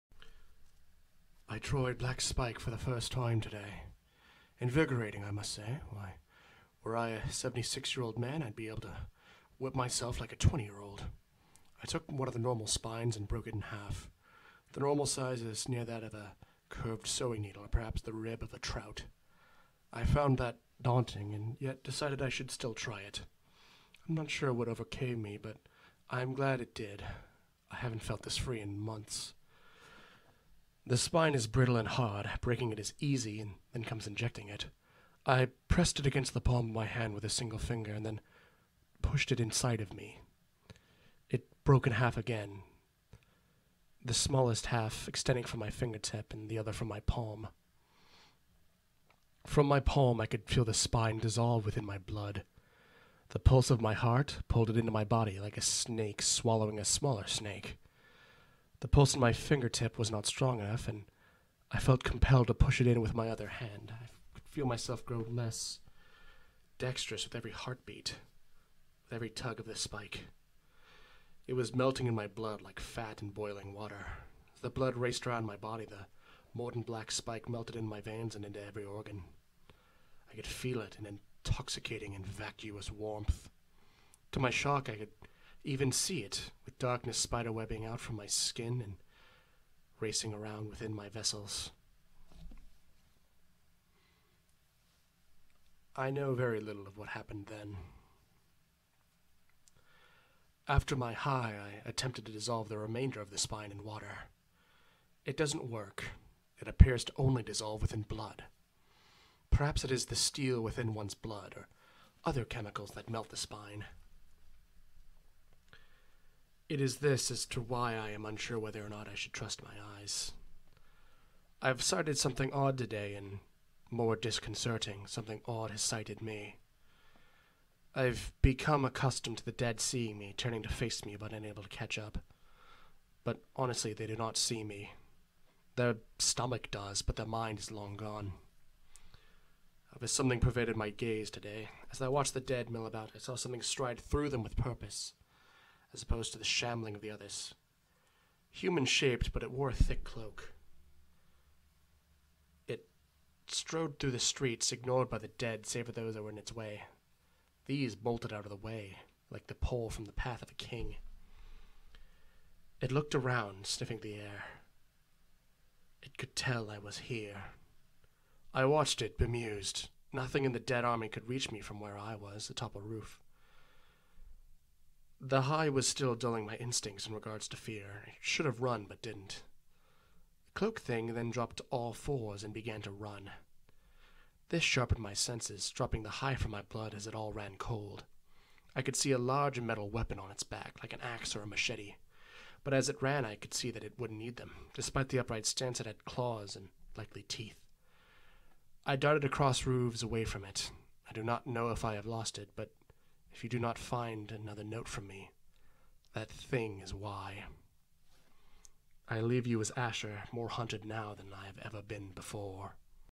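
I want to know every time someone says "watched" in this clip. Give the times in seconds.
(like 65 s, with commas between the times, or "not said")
142 s, 168 s.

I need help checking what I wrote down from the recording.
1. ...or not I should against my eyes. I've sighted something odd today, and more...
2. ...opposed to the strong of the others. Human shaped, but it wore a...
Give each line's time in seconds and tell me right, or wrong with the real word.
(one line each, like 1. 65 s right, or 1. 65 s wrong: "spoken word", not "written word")
1. 118 s wrong: "trust", not "against"
2. 146 s wrong: "shambling", not "strong".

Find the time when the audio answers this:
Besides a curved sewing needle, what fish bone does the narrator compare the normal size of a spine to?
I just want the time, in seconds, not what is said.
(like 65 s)
18 s.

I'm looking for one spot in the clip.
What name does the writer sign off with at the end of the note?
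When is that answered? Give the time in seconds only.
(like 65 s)
209 s.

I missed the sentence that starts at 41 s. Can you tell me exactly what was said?
It broke in half again, the smallest half extending from my fingertip and the other from my palm.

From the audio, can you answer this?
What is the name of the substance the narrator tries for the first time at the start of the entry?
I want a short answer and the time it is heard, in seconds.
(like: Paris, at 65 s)
Troy Black Spike, at 1 s.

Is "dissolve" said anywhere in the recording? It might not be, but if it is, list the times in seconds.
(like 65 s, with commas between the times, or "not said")
51 s, 102 s, 107 s.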